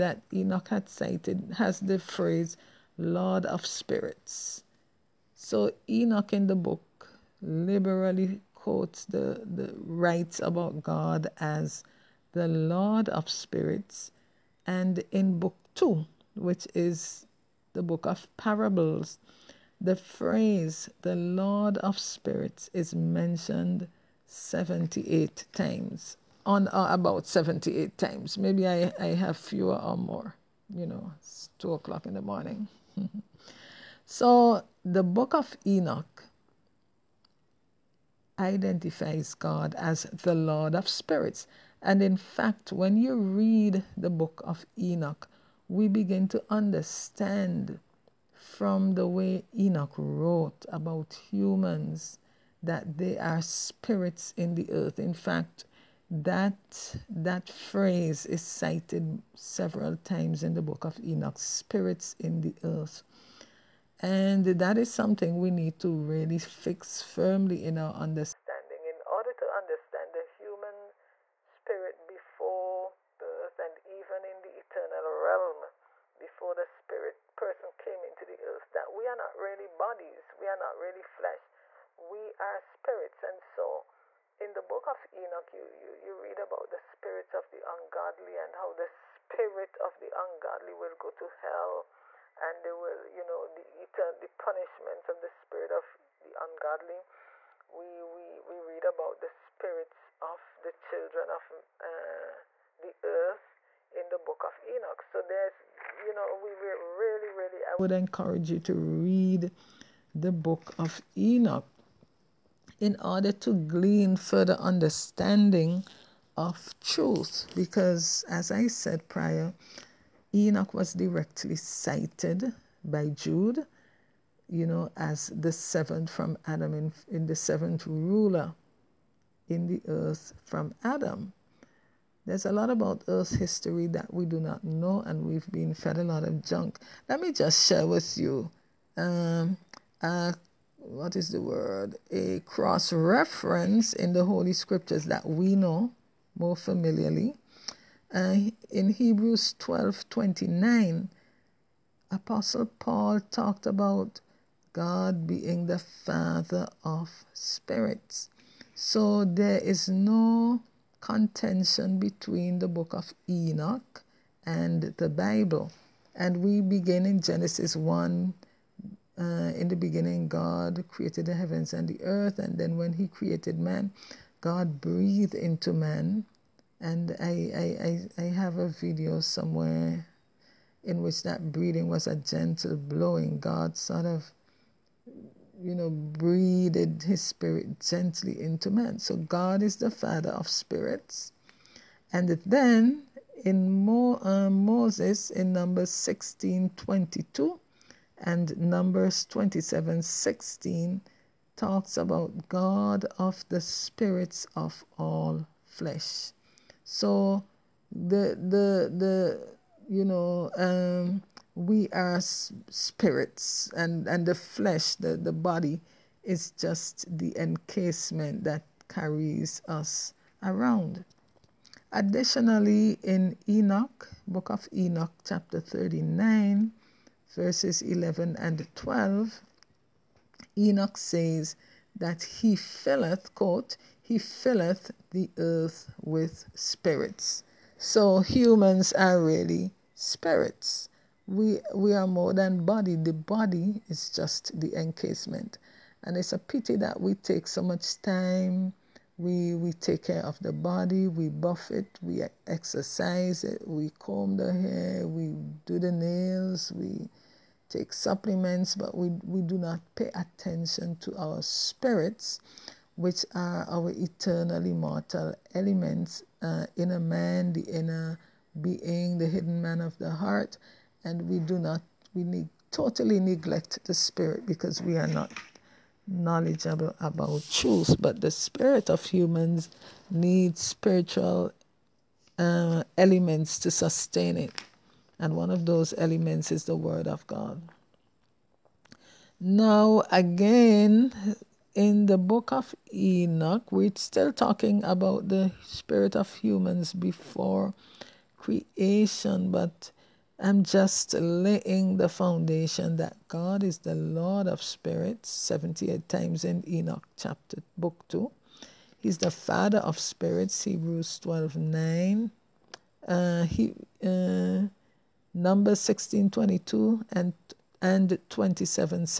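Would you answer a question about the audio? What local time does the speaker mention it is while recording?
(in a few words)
2 o'clock in the morning.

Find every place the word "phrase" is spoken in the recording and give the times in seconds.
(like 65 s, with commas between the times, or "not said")
1 s, 19 s, 57 s.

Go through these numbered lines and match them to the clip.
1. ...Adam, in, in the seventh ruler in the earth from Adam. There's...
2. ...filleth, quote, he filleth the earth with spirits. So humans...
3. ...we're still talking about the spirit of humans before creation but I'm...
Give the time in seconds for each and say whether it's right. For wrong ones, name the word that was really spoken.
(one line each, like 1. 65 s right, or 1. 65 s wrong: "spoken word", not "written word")
1. 126 s right
2. 232 s right
3. 293 s right.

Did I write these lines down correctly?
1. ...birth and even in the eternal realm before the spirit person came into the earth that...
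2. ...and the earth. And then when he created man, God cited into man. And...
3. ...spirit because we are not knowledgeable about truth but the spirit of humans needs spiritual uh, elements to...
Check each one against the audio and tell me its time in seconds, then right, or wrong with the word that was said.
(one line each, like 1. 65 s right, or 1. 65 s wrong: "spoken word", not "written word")
1. 73 s right
2. 171 s wrong: "breathed", not "cited"
3. 273 s right.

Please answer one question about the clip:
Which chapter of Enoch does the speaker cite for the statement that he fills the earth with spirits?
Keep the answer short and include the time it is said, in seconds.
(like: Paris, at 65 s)
39, at 225 s.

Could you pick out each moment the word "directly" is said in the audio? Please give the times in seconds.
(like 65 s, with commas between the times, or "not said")
120 s.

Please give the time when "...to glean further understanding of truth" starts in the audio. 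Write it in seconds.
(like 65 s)
113 s.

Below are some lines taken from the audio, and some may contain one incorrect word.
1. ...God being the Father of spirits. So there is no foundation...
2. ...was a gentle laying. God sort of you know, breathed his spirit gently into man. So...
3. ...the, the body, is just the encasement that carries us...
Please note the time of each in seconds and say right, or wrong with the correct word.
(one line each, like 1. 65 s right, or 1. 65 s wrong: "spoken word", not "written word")
1. 154 s wrong: "contention", not "foundation"
2. 181 s wrong: "blowing", not "laying"
3. 214 s right.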